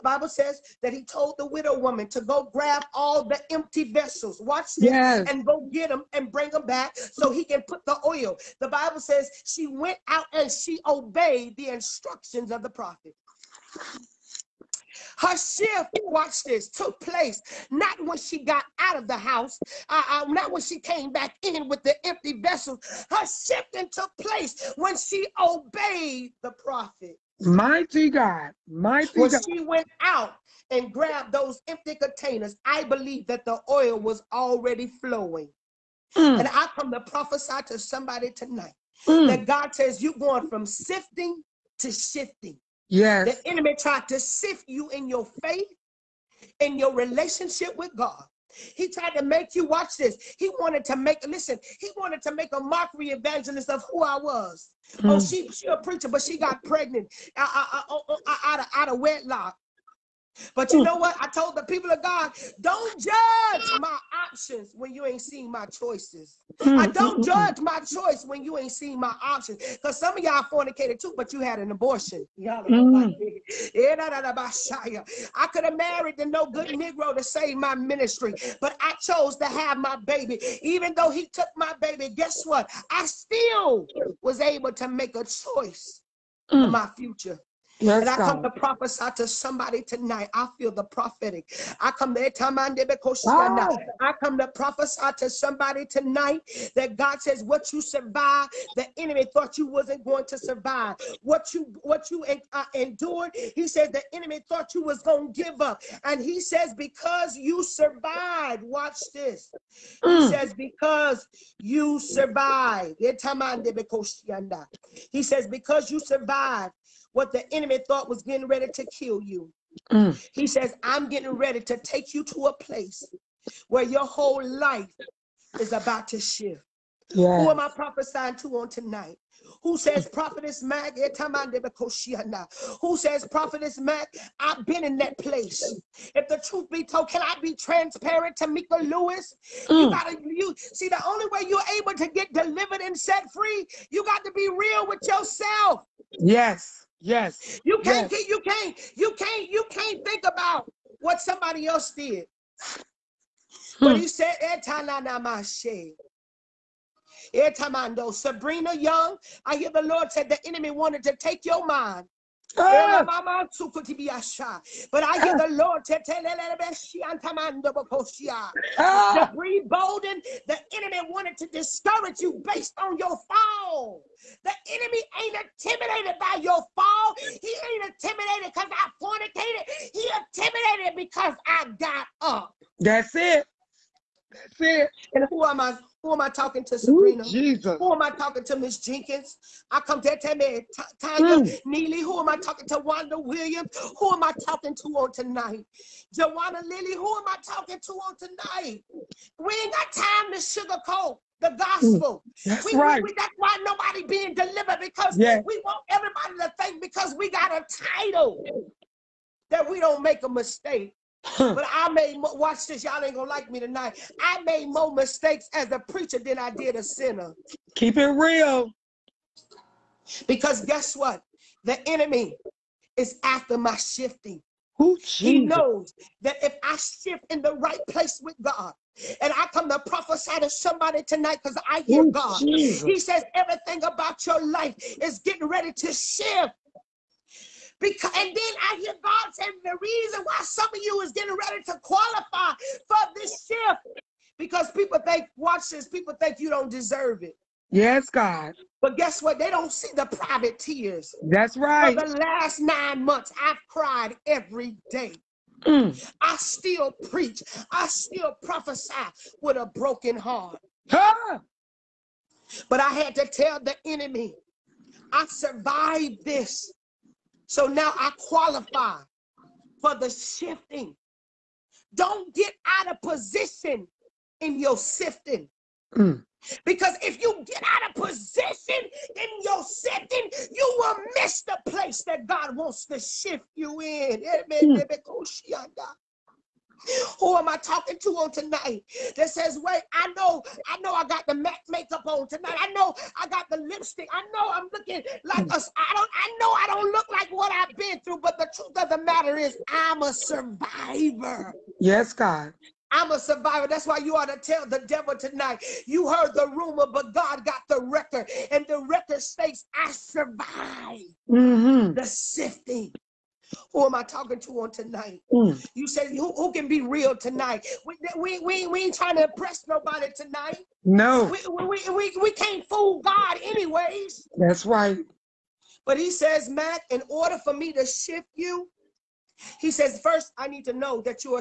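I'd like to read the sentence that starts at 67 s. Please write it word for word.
judge my choice when you ain't seeing my options.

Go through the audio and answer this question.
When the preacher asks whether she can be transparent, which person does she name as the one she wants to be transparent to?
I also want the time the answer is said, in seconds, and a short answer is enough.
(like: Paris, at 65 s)
Mika Lewis, at 138 s.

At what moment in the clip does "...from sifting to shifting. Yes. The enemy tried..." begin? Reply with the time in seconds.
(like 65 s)
40 s.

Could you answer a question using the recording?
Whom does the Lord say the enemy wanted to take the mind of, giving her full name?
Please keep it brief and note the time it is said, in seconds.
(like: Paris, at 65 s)
Sabrina Young, at 158 s.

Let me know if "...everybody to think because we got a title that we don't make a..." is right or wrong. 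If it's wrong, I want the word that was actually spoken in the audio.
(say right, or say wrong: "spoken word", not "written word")
right.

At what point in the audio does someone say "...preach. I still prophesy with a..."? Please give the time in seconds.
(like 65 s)
257 s.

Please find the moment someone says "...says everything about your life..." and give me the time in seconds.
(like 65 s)
232 s.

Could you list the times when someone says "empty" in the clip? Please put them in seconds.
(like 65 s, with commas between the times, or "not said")
3 s, 22 s, 31 s.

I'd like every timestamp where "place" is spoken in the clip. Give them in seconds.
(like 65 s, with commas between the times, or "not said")
17 s, 24 s, 122 s, 135 s, 227 s, 281 s.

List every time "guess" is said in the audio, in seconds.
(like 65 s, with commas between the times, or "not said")
82 s, 220 s, 248 s.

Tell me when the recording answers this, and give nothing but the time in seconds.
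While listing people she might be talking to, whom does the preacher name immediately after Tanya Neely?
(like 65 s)
192 s.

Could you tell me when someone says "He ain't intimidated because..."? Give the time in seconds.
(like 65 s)
177 s.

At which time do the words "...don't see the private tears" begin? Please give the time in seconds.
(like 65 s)
249 s.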